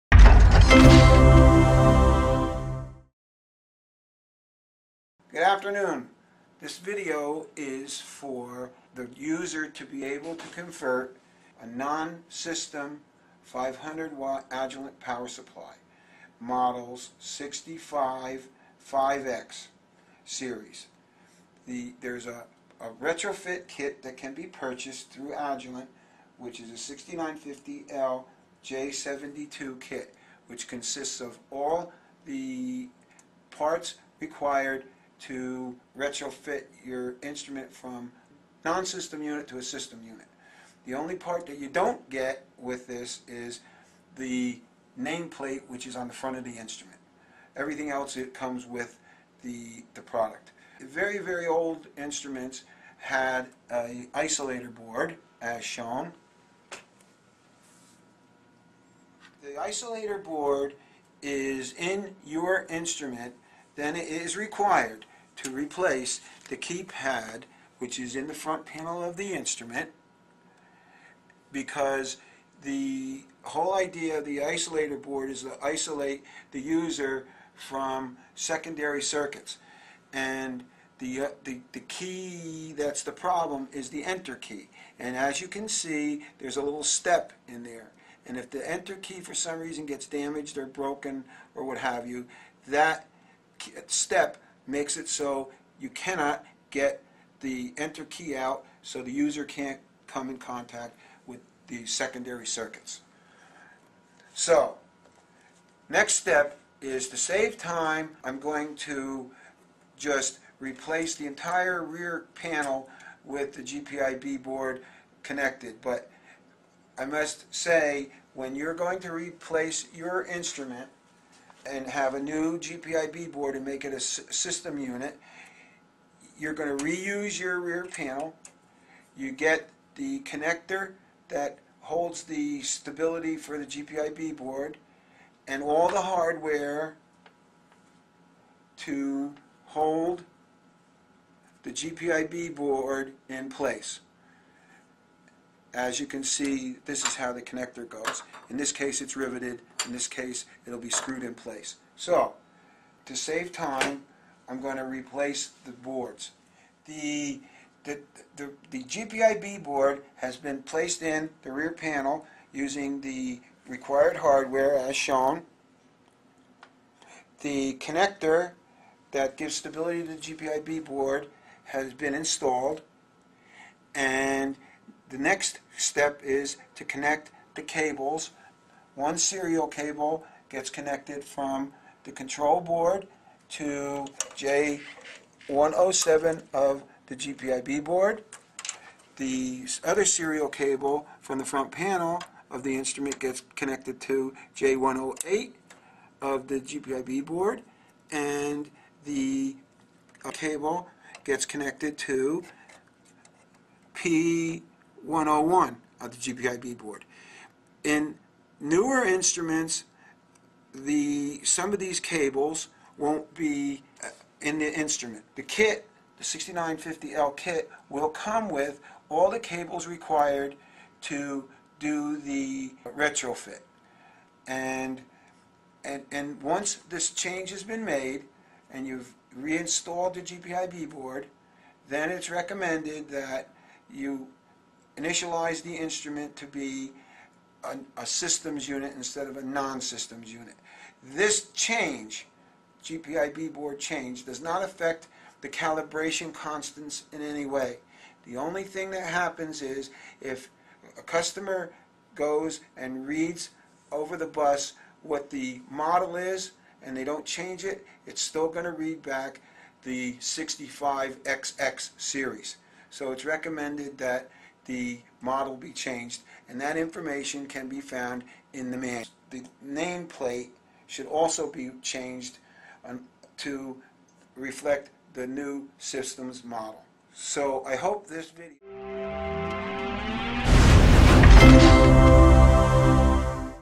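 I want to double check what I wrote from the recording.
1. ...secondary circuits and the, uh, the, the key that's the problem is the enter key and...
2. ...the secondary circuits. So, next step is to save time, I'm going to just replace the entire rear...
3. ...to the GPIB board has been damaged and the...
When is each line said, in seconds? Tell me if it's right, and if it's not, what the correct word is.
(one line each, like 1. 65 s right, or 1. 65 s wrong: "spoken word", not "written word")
1. 78 s right
2. 101 s right
3. 170 s wrong: "installed", not "damaged".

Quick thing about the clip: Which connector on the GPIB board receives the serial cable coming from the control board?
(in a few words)
J107.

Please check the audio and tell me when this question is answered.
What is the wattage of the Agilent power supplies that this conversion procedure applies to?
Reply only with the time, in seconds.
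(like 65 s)
13 s.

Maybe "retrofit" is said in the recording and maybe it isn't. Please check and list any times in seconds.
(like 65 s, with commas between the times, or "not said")
23 s, 35 s, 222 s.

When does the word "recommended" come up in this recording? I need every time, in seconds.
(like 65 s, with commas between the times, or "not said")
232 s, 263 s.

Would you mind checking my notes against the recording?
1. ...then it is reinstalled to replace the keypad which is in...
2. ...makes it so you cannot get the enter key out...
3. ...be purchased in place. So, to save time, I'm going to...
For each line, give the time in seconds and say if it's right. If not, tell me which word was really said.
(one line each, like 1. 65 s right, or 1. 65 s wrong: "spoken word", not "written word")
1. 63 s wrong: "required", not "reinstalled"
2. 94 s right
3. 150 s wrong: "screwed", not "purchased".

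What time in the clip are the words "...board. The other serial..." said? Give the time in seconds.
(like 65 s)
187 s.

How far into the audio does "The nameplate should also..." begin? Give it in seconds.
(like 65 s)
269 s.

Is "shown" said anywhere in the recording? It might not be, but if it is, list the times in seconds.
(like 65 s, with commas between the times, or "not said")
55 s, 164 s.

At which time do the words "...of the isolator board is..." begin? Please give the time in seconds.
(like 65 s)
74 s.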